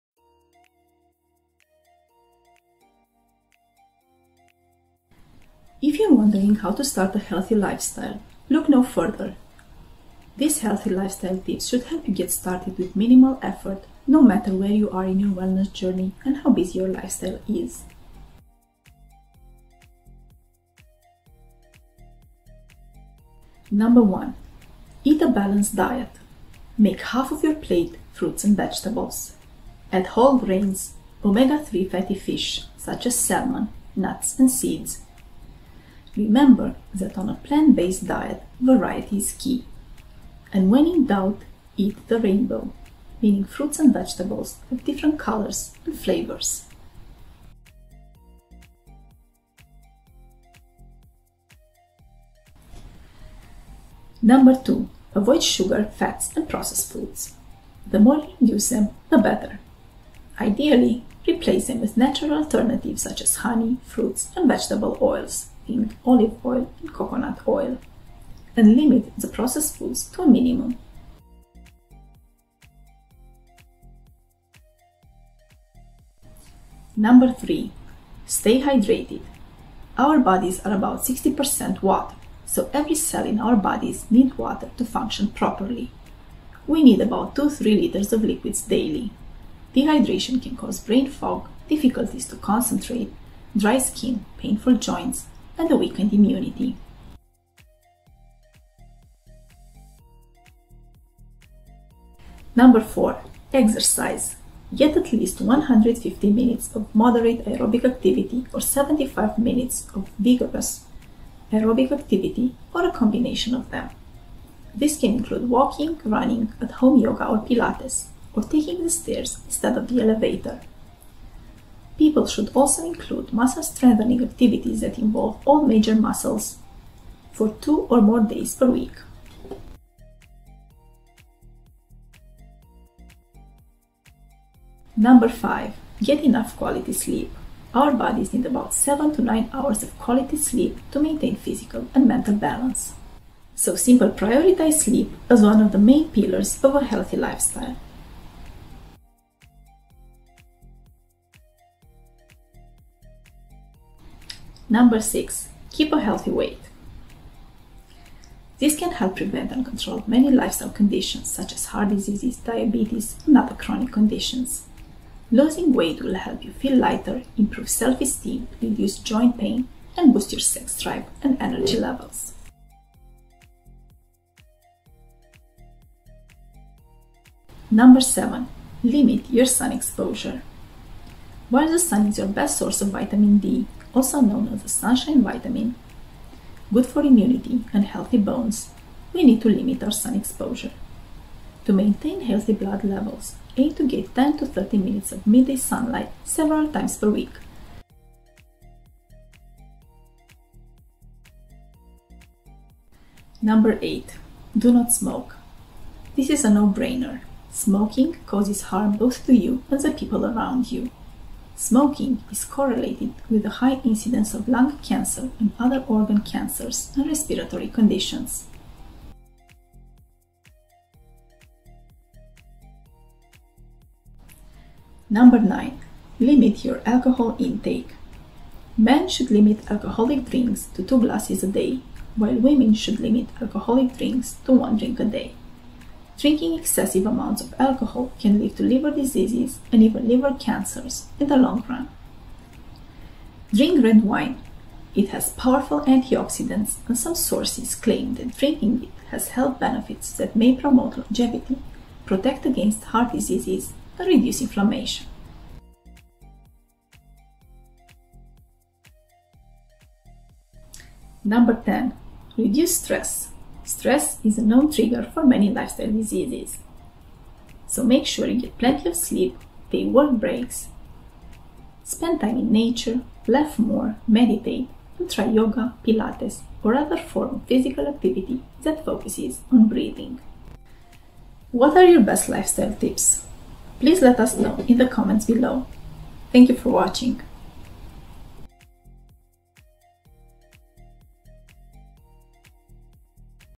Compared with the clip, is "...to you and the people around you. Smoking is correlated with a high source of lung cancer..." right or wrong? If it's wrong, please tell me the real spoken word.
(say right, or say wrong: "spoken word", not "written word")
wrong: "incidence", not "source".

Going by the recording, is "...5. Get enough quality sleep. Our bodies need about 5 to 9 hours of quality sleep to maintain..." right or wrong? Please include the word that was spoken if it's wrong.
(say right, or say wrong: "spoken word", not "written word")
wrong: "7", not "5".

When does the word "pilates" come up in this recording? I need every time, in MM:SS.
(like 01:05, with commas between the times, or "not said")
01:57, 04:35.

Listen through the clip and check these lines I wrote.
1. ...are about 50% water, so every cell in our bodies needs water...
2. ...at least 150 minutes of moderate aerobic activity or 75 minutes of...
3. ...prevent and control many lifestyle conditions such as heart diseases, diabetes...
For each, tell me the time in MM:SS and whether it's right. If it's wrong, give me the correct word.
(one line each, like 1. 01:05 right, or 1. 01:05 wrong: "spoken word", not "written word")
1. 01:20 wrong: "60", not "50"
2. 01:44 right
3. 02:39 right.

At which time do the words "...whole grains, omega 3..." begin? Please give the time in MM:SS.
00:30.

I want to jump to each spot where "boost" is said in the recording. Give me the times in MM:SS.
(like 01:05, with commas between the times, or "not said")
02:50.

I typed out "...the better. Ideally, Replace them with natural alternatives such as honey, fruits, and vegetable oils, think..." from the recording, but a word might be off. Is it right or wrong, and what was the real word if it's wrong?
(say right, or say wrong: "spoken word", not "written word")
right.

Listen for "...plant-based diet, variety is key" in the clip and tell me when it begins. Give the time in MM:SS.
00:37.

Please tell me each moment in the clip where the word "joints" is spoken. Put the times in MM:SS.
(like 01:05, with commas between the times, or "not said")
01:34, 02:48.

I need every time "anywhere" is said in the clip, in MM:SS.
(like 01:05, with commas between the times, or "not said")
not said.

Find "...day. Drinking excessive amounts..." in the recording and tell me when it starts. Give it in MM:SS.
03:55.